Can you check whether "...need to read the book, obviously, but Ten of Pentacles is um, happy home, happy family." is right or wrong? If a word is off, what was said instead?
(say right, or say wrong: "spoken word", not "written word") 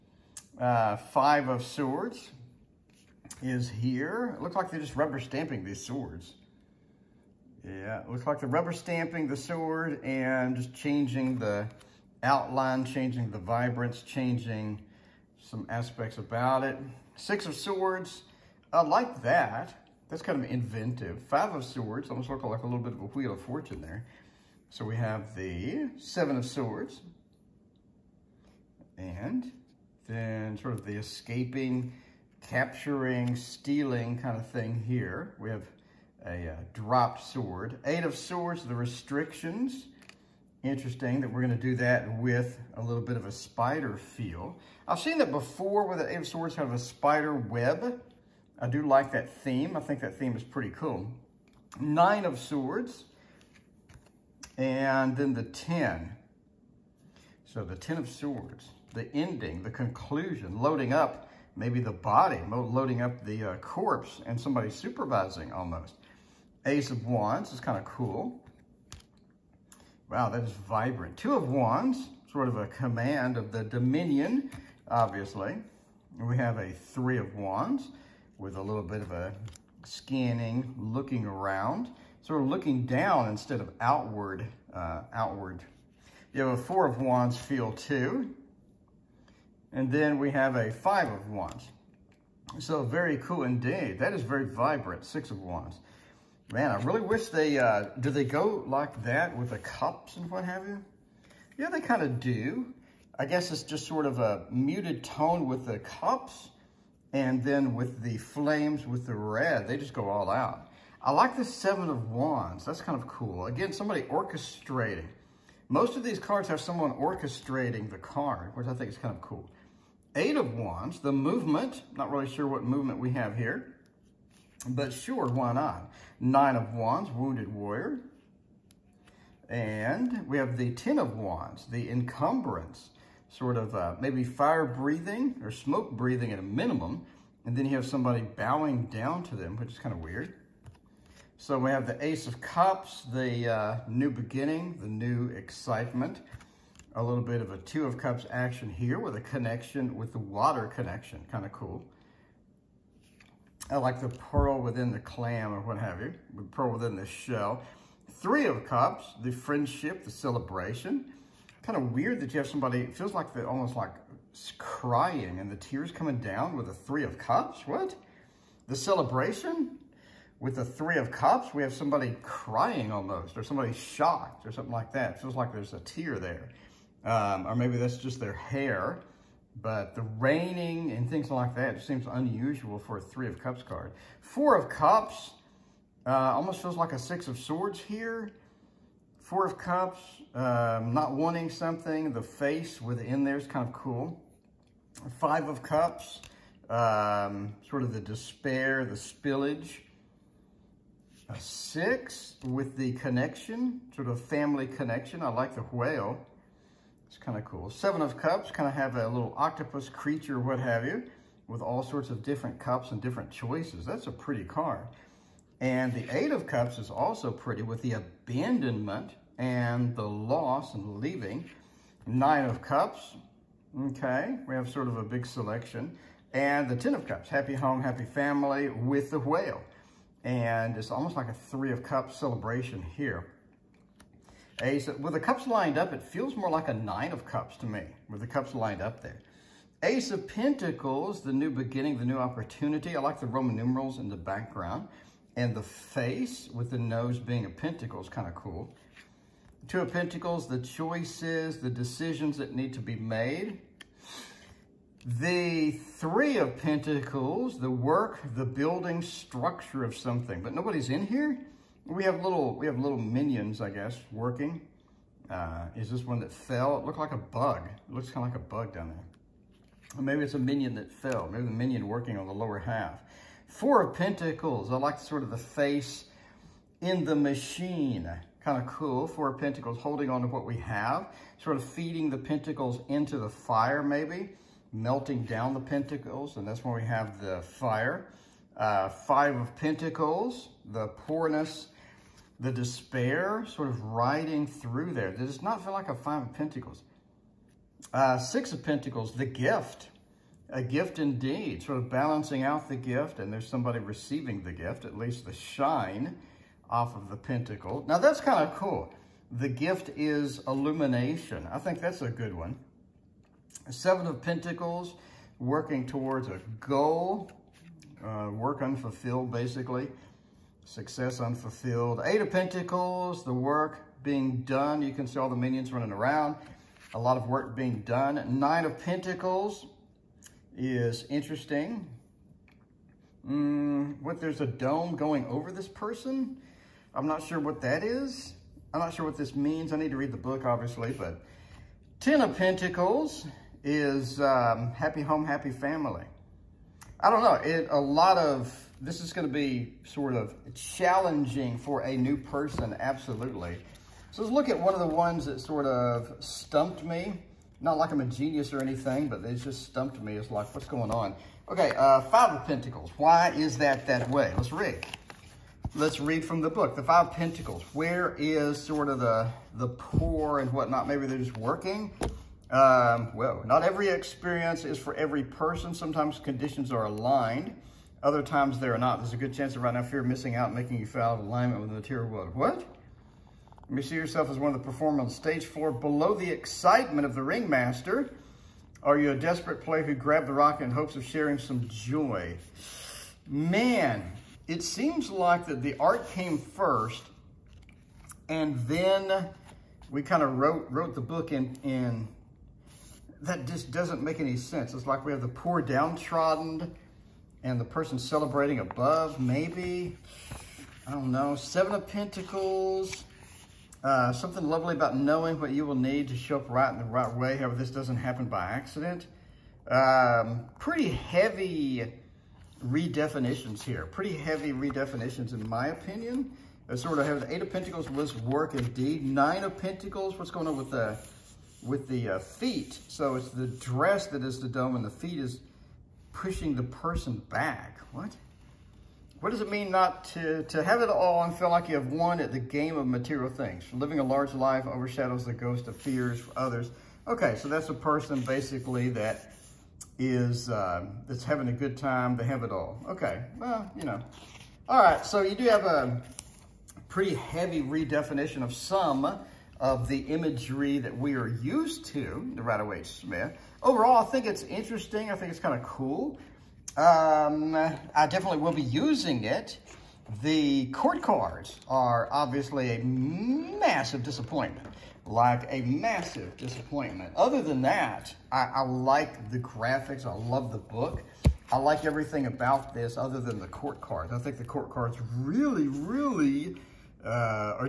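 right.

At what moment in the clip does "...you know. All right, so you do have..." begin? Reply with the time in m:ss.
7:33.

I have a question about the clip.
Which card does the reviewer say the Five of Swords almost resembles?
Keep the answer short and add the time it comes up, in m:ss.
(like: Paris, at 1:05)
Wheel of Fortune, at 0:23.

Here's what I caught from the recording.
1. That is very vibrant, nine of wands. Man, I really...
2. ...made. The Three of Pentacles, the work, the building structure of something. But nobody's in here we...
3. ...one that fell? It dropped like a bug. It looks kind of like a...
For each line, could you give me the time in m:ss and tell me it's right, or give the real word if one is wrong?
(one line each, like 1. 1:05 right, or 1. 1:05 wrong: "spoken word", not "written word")
1. 1:33 wrong: "six", not "nine"
2. 4:12 right
3. 4:26 wrong: "looked", not "dropped".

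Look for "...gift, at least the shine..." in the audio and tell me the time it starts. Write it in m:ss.
5:04.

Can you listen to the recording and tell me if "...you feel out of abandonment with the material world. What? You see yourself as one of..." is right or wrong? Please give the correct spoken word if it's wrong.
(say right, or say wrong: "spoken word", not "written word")
wrong: "alignment", not "abandonment".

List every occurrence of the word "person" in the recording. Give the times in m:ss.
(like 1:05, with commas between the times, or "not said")
5:35, 5:52, 6:15, 6:47, 7:16, 7:27.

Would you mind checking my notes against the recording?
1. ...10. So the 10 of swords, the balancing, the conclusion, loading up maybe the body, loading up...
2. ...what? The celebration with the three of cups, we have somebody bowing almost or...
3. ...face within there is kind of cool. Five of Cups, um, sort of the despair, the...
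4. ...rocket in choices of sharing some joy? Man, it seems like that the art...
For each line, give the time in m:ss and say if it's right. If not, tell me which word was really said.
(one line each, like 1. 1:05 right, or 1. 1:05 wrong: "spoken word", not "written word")
1. 0:55 wrong: "ending", not "balancing"
2. 2:47 wrong: "crying", not "bowing"
3. 3:12 right
4. 6:30 wrong: "hopes", not "choices".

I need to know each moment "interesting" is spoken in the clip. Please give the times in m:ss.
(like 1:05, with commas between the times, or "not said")
0:40, 5:31, 7:44.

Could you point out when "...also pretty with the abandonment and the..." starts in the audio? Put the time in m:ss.
3:36.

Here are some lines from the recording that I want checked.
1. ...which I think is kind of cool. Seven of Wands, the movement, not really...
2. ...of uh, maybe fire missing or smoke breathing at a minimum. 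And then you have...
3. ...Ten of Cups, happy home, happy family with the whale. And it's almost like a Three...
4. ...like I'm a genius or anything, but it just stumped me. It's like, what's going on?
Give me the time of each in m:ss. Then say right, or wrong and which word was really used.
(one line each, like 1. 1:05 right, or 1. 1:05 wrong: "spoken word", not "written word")
1. 1:58 wrong: "Eight", not "Seven"
2. 2:13 wrong: "breathing", not "missing"
3. 3:46 right
4. 5:57 right.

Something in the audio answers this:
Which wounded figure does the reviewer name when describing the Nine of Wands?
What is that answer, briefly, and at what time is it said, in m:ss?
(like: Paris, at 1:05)
Wounded Warrior, at 2:07.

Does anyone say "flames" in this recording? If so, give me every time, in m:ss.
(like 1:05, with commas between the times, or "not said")
1:48.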